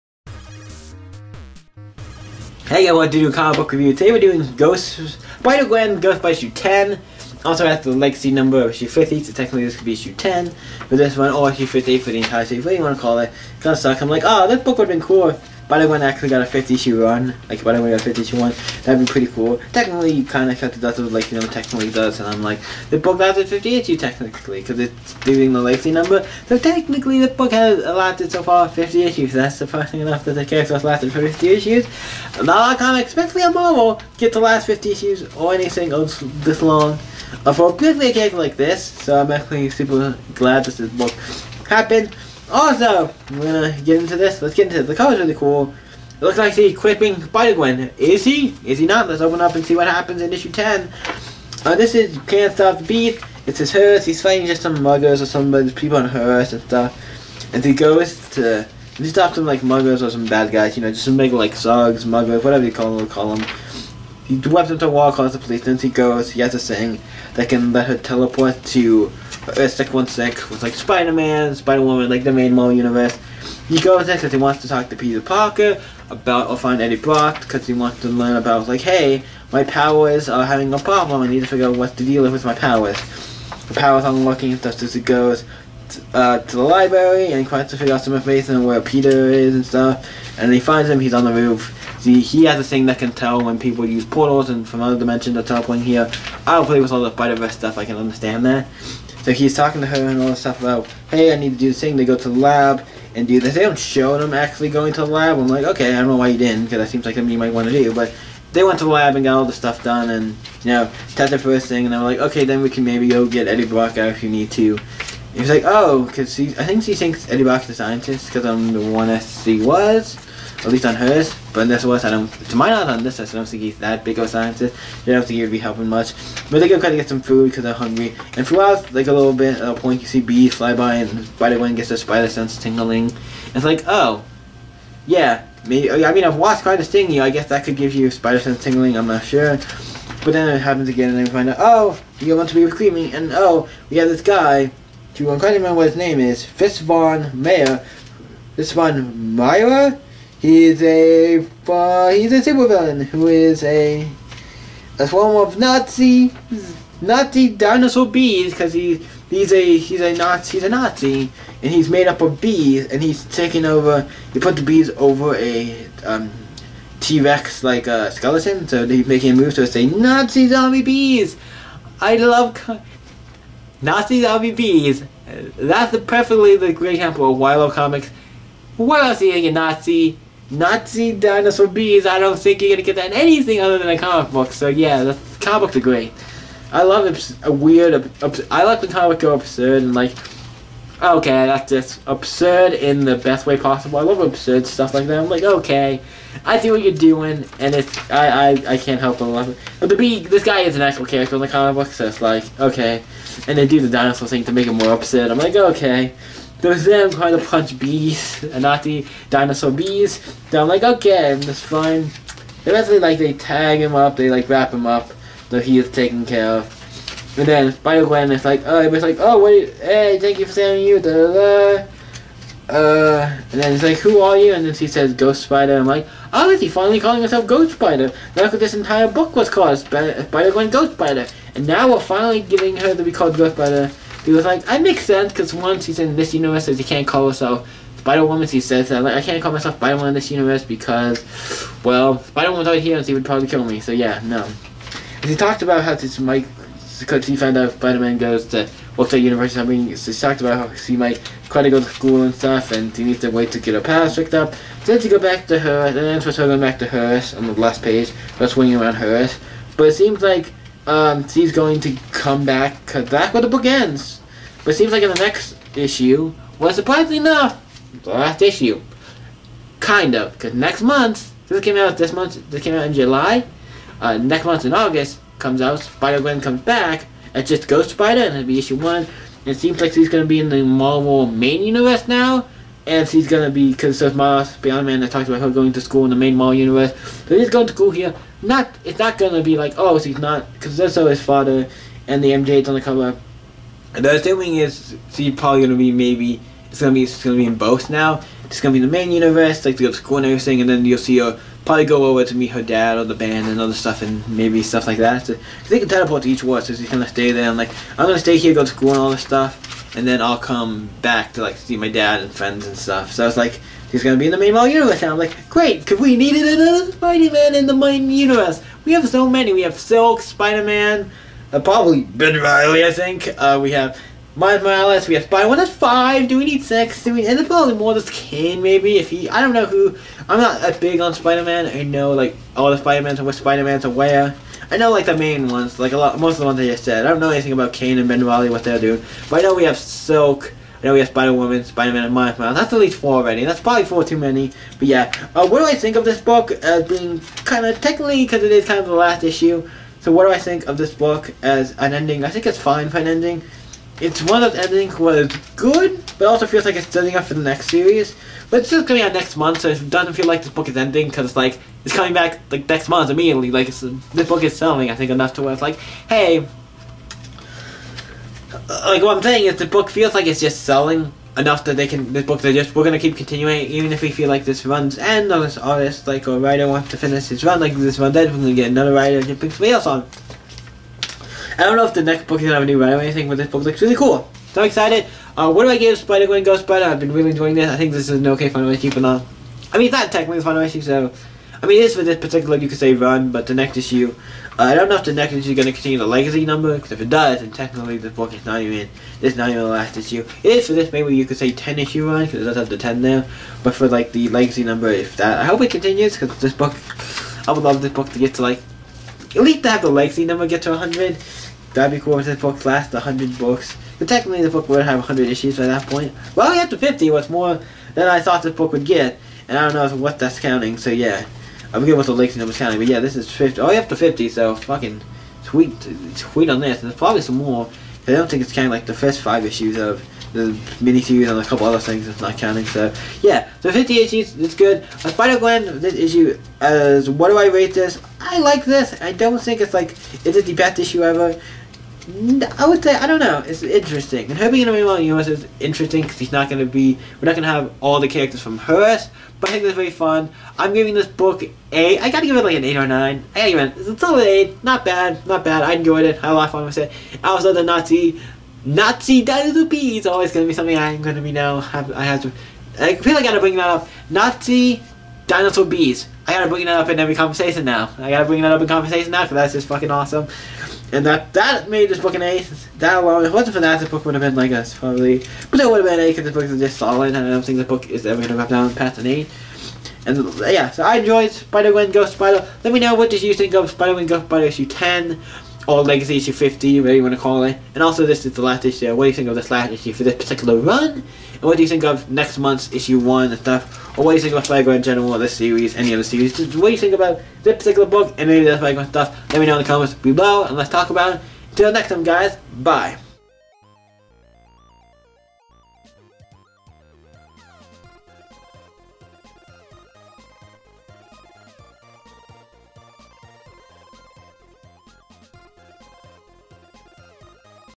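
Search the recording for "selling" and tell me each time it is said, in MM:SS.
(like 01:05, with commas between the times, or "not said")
06:04, 06:10.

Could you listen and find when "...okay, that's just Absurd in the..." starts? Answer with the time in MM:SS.
03:11.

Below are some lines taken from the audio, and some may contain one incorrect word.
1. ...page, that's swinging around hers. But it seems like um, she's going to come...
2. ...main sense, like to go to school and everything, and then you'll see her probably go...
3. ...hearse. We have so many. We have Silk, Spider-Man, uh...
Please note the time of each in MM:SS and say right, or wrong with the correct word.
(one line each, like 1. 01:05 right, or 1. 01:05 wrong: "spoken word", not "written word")
1. 04:17 right
2. 04:58 wrong: "universe", not "sense"
3. 05:18 wrong: "universe", not "hearse".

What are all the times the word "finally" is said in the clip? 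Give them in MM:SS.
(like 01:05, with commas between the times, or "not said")
03:46, 03:51.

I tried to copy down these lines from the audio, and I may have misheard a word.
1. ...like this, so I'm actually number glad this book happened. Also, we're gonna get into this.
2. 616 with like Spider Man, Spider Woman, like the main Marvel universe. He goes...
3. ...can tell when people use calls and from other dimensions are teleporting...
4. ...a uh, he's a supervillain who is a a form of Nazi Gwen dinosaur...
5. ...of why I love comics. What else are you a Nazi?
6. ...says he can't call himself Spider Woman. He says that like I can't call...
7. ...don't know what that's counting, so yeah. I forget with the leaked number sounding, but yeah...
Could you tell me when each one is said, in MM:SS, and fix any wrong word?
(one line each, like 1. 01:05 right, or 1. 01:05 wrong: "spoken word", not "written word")
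1. 00:38 wrong: "super", not "number"
2. 01:10 right
3. 01:32 wrong: "portals", not "calls"
4. 02:30 wrong: "Nazi", not "Gwen"
5. 02:57 right
6. 03:56 right
7. 06:59 right.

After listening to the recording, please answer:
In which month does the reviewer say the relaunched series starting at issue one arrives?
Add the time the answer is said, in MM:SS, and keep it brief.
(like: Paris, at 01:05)
August, at 04:34.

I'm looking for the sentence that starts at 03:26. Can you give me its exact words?
There's them trying to punch bees and not the dinosaur bees.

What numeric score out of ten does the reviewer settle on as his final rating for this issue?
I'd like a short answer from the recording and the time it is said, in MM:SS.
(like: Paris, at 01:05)
8, at 07:34.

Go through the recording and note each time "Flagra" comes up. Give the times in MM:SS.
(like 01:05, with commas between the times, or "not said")
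08:14, 08:18.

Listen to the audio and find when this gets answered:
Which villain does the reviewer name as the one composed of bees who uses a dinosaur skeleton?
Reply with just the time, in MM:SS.
02:26.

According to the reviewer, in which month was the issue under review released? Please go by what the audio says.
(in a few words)
July.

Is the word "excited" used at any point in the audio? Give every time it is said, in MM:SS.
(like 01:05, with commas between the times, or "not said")
06:24.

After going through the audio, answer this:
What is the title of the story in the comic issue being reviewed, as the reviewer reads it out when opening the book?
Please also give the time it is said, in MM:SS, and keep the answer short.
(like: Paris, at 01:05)
Can't Stop the Beat, at 00:52.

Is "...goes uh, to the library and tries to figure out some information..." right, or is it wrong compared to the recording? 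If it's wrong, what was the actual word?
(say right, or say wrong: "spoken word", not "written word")
right.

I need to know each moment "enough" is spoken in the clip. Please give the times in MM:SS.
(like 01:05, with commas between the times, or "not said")
00:30, 04:27, 06:05, 06:11.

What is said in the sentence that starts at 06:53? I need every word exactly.
But technically, the book would have 100 issues by that point.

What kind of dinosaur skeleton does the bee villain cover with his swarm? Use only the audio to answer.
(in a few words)
T-Rex.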